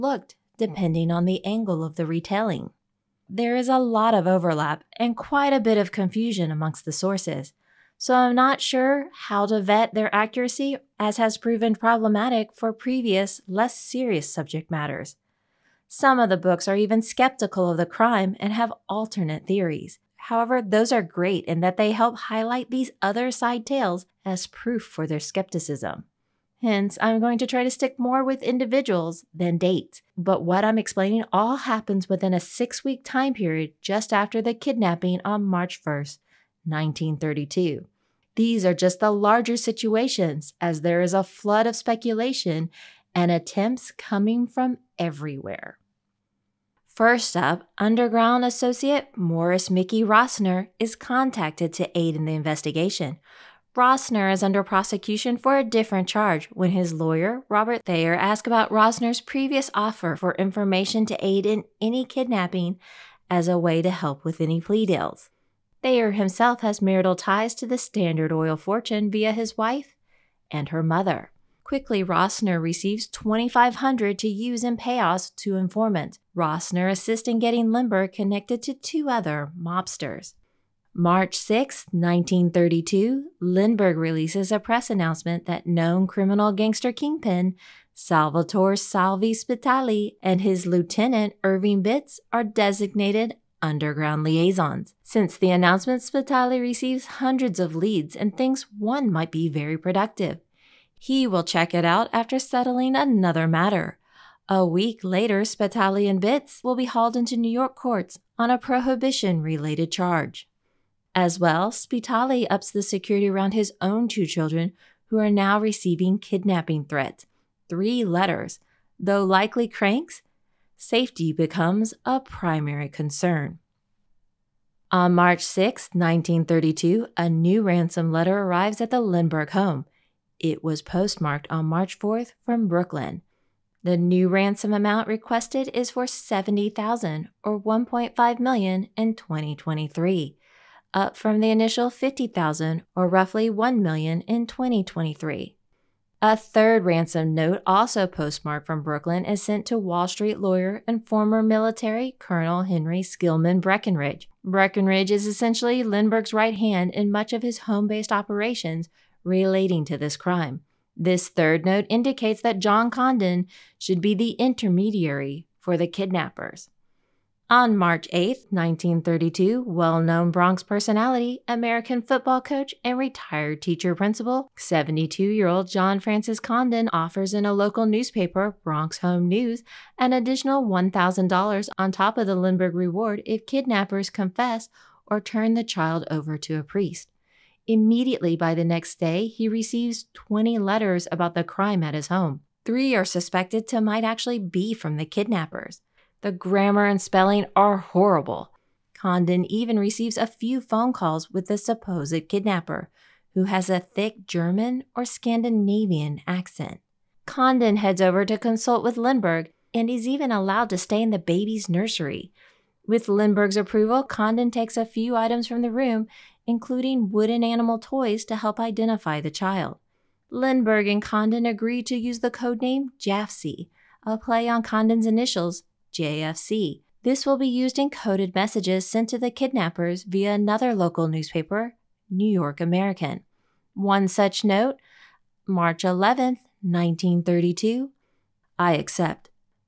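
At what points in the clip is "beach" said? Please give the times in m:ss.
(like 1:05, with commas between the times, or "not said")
not said.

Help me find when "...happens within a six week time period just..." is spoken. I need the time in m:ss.
0:31.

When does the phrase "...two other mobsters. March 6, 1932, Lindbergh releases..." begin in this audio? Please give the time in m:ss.
1:18.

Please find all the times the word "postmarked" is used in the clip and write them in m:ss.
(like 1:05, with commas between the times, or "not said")
2:10, 2:28.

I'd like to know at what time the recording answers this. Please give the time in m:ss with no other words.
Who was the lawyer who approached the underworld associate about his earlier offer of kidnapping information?
0:57.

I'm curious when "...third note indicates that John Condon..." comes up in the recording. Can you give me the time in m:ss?
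2:41.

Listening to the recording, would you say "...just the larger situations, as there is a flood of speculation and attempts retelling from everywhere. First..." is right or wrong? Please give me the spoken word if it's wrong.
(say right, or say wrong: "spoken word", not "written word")
wrong: "coming", not "retelling".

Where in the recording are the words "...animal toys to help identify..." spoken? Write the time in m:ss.
3:37.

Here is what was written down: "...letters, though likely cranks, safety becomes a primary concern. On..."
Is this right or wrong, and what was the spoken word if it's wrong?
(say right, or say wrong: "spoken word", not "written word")
right.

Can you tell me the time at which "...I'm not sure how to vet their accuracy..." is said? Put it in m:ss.
0:08.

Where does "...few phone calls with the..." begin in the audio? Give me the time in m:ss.
3:20.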